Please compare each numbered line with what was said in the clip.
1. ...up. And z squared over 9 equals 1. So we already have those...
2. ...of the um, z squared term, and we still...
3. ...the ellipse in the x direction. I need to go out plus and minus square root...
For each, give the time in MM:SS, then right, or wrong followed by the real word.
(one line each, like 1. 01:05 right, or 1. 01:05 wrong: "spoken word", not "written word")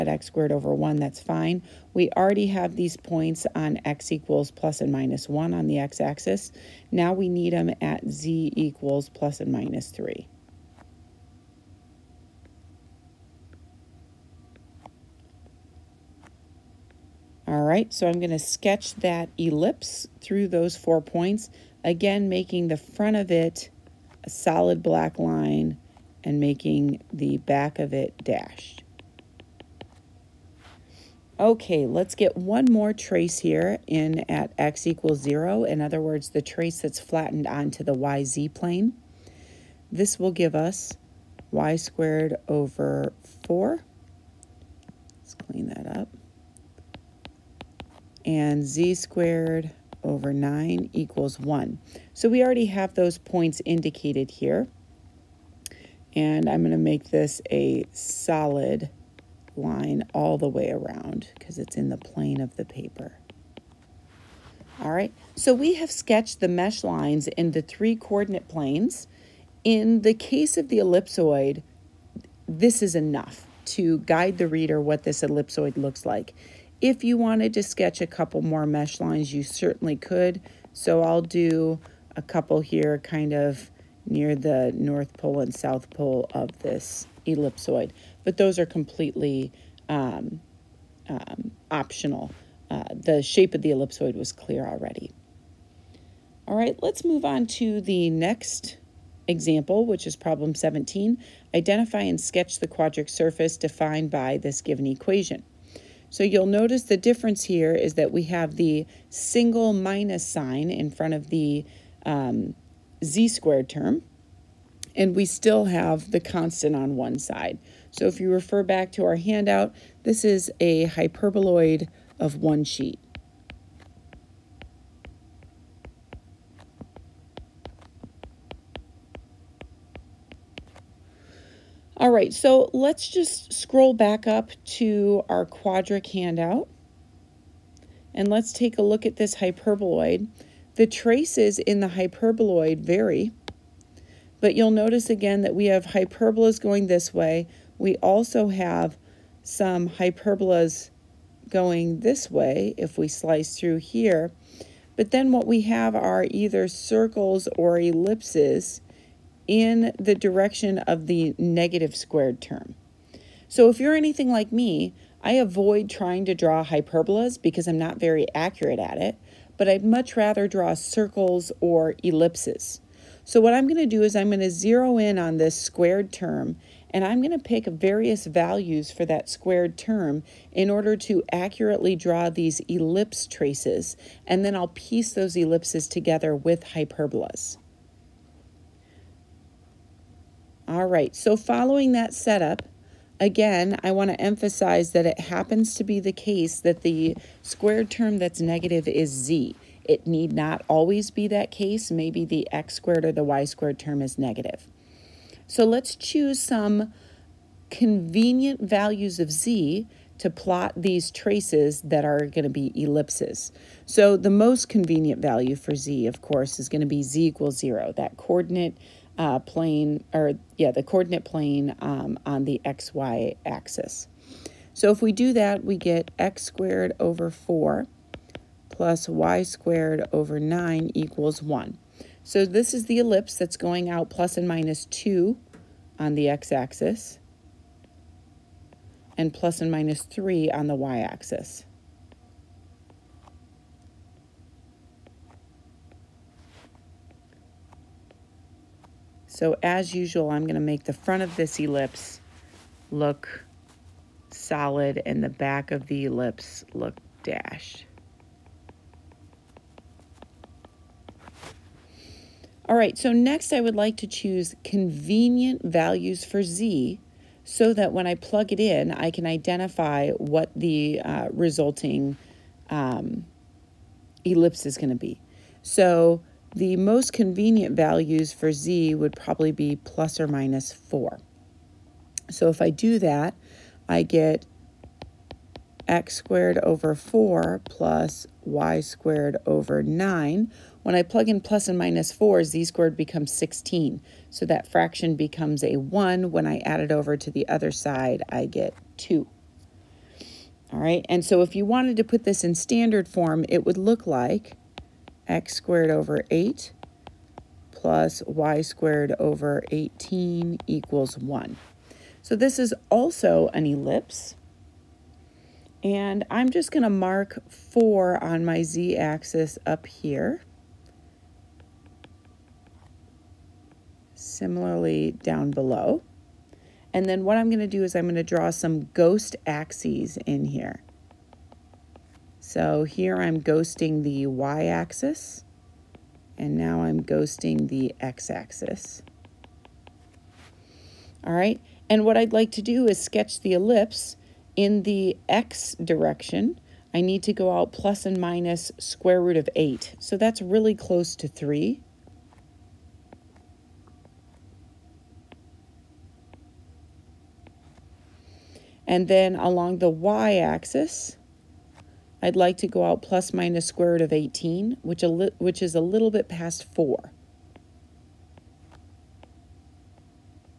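1. 00:45 right
2. 01:51 right
3. 05:43 right.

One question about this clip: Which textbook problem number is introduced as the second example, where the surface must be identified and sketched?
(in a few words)
17.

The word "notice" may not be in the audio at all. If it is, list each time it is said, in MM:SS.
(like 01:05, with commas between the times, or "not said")
01:46, 02:24.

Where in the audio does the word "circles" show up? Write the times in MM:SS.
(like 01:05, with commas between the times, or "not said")
02:36, 02:50.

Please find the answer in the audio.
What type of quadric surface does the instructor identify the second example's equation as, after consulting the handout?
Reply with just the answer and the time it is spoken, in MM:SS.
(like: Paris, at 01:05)
hyperboloid of one sheet, at 02:00.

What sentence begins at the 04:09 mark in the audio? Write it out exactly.
So as usual, I'm going to make the front of this ellipse look solid and the back of the ellipse look dashed.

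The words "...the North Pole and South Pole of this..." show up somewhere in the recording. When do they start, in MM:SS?
01:24.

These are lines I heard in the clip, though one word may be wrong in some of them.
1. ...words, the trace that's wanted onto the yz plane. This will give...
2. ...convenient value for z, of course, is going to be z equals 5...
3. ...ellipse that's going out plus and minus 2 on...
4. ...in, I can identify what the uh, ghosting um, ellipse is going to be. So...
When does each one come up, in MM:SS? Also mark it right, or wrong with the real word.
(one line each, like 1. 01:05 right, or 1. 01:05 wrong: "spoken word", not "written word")
1. 00:36 wrong: "flattened", not "wanted"
2. 03:34 wrong: "0", not "5"
3. 03:52 right
4. 04:28 wrong: "resulting", not "ghosting".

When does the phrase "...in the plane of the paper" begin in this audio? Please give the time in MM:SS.
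01:01.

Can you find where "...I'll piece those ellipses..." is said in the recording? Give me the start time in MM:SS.
03:04.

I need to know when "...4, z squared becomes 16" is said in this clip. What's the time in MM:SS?
04:52.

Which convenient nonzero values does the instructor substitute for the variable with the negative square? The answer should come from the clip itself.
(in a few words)
plus or minus 4.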